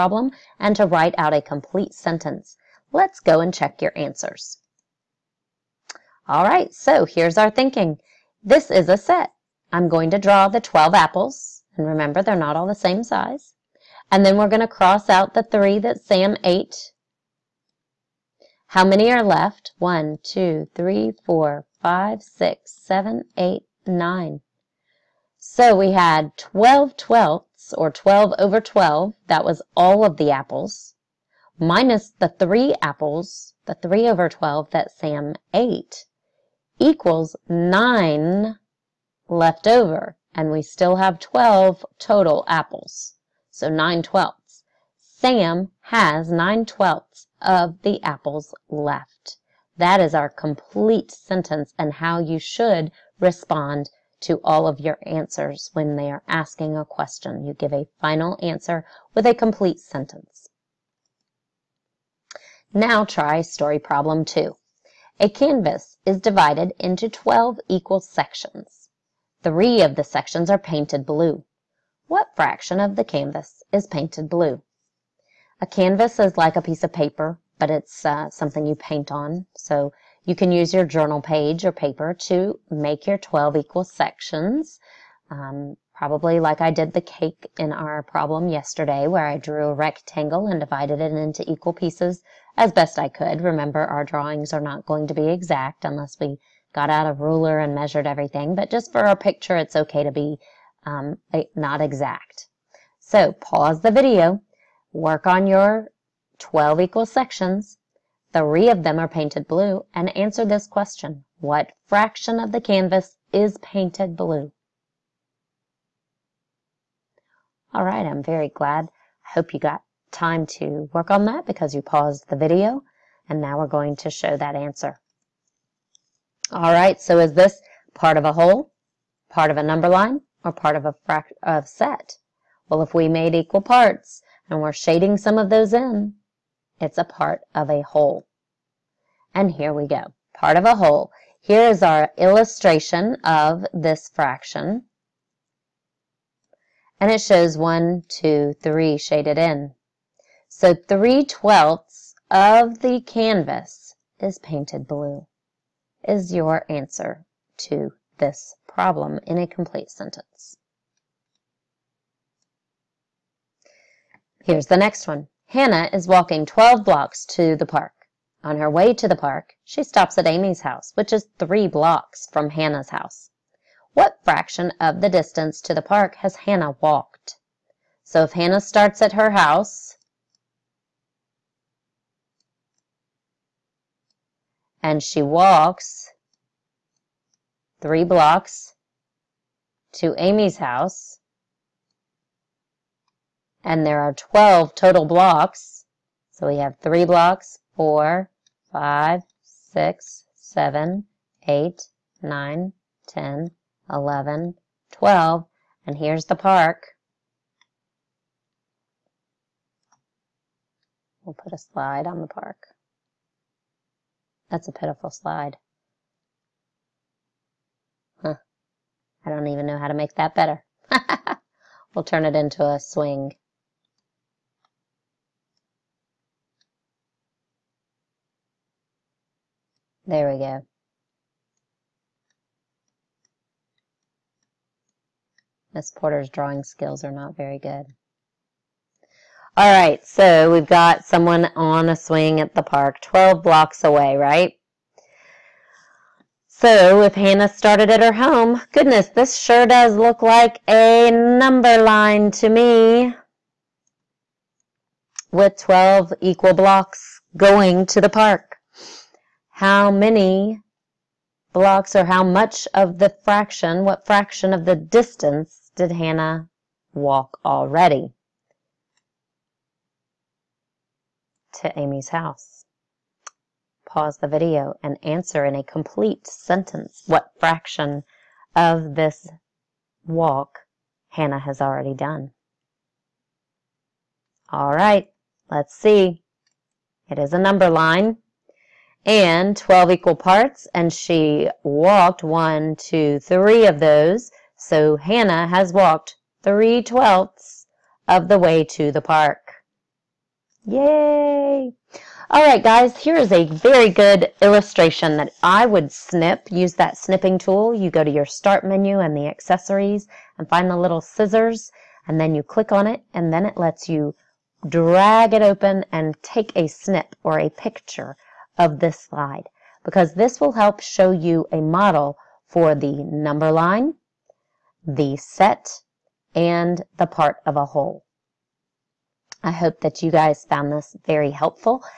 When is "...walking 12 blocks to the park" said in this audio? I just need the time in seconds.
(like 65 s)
166 s.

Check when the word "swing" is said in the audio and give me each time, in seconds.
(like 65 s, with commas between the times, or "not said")
222 s, 241 s.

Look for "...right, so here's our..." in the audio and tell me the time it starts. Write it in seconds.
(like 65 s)
6 s.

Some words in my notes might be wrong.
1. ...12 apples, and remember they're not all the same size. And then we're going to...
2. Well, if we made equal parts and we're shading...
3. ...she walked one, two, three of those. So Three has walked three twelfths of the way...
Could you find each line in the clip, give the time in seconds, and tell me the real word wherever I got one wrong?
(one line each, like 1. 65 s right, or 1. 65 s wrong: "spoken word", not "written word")
1. 10 s right
2. 132 s right
3. 290 s wrong: "Hannah", not "Three".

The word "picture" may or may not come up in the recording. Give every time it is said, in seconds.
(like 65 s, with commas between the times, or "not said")
99 s, 317 s.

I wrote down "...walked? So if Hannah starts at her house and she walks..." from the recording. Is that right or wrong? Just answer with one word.
right.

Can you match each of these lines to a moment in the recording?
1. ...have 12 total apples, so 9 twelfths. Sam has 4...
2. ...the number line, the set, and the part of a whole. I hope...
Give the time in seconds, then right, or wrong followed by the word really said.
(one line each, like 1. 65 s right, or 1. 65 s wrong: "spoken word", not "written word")
1. 40 s wrong: "9", not "4"
2. 322 s right.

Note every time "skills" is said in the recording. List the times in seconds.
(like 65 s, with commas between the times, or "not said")
236 s.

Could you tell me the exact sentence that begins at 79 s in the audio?
So you can use your journal page or paper to make your 12 equal sections.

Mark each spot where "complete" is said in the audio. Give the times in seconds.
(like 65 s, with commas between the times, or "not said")
1 s, 50 s, 59 s, 159 s, 275 s.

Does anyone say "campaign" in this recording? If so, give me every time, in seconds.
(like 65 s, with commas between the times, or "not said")
not said.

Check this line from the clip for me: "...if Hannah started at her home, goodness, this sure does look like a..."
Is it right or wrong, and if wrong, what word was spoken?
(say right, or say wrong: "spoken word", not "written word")
right.